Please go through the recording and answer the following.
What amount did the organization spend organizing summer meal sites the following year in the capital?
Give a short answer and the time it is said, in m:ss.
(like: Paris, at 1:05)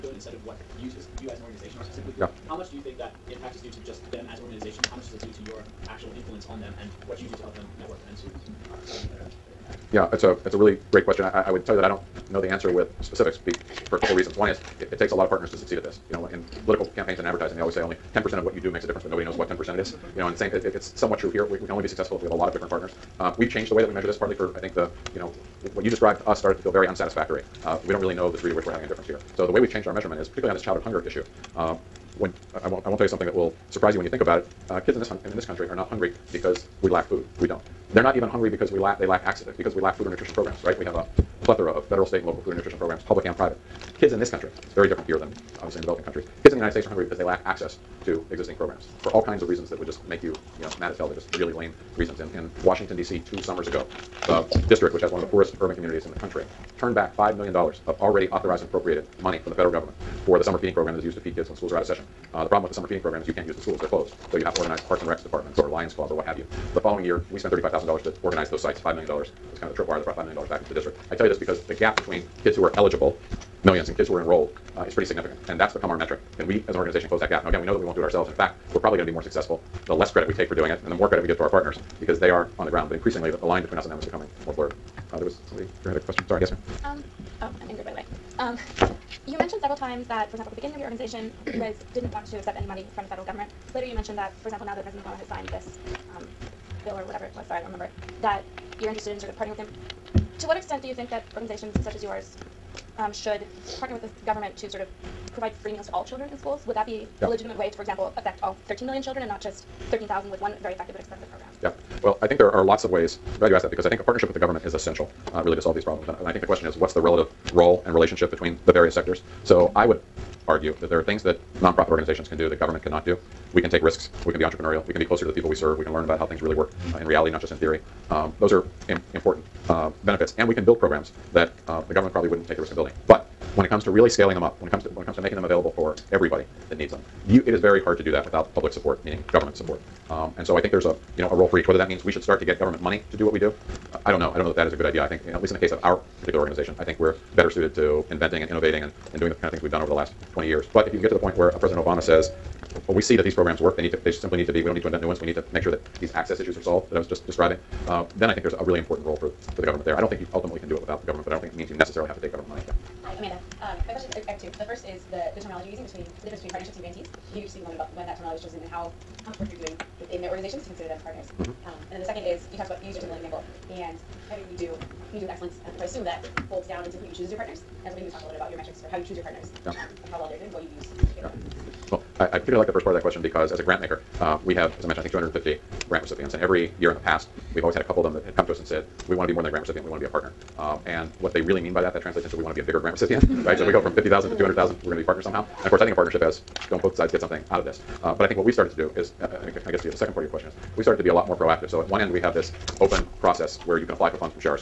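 $35,000, at 1:07.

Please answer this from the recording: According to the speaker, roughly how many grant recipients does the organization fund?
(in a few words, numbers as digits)
250.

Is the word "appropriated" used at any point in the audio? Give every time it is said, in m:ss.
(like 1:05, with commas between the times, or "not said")
0:58.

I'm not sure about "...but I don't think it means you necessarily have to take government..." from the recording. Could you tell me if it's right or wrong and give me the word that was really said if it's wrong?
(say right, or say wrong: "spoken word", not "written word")
right.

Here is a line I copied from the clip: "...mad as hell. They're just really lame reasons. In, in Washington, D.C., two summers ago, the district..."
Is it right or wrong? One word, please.
right.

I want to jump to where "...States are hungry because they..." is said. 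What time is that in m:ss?
0:46.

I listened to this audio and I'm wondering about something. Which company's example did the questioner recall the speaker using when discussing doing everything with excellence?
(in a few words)
Timberland.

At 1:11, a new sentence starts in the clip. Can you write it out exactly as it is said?
I tell you this because the gap between kids who are eligible, millions, and kids who are enrolled uh, is pretty significant.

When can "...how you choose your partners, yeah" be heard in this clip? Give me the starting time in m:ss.
2:58.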